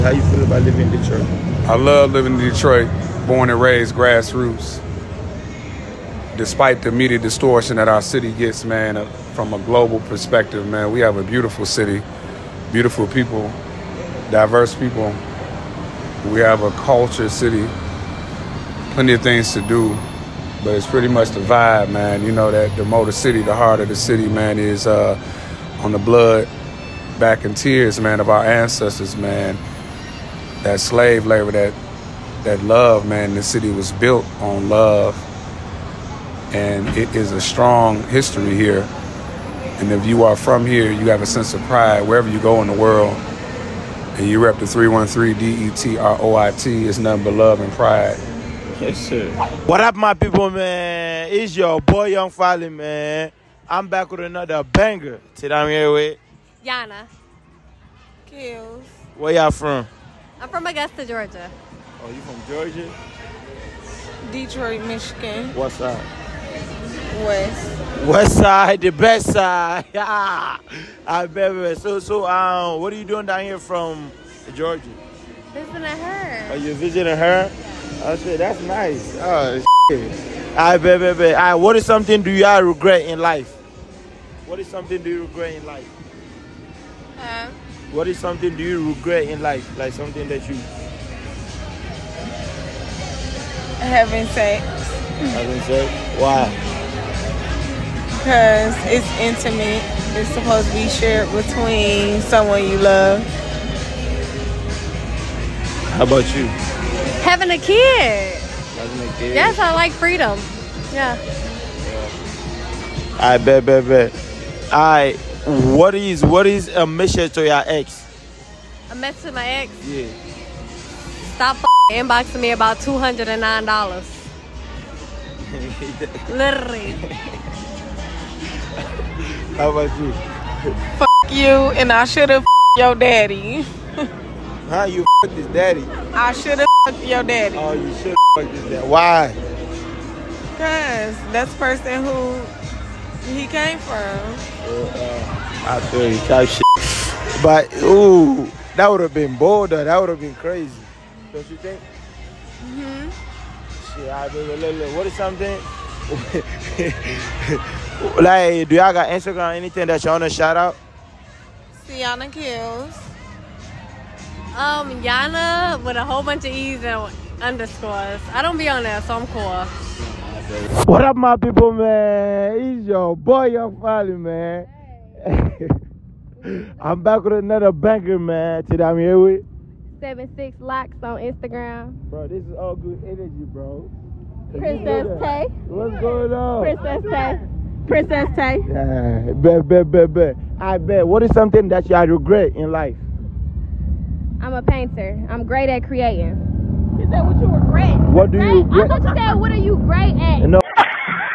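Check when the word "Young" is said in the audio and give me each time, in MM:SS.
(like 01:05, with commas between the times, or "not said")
00:52, 02:53.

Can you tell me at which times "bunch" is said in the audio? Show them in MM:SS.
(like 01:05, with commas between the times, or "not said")
02:46.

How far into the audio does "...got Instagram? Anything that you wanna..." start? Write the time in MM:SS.
02:38.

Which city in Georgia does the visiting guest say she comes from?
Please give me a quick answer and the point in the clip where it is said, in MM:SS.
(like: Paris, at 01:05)
Augusta, at 01:00.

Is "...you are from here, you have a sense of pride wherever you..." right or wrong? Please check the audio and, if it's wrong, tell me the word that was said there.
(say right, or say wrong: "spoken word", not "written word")
right.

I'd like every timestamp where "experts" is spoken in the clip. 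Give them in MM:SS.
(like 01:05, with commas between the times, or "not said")
not said.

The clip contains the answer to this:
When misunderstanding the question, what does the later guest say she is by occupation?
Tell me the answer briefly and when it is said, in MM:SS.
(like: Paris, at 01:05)
Painter, at 03:14.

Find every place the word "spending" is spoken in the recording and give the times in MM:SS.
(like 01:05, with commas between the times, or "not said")
not said.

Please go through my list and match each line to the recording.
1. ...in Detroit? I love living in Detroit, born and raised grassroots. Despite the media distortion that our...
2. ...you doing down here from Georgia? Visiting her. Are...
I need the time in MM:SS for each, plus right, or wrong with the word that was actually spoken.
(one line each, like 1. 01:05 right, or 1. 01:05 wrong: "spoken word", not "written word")
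1. 00:00 right
2. 01:12 right.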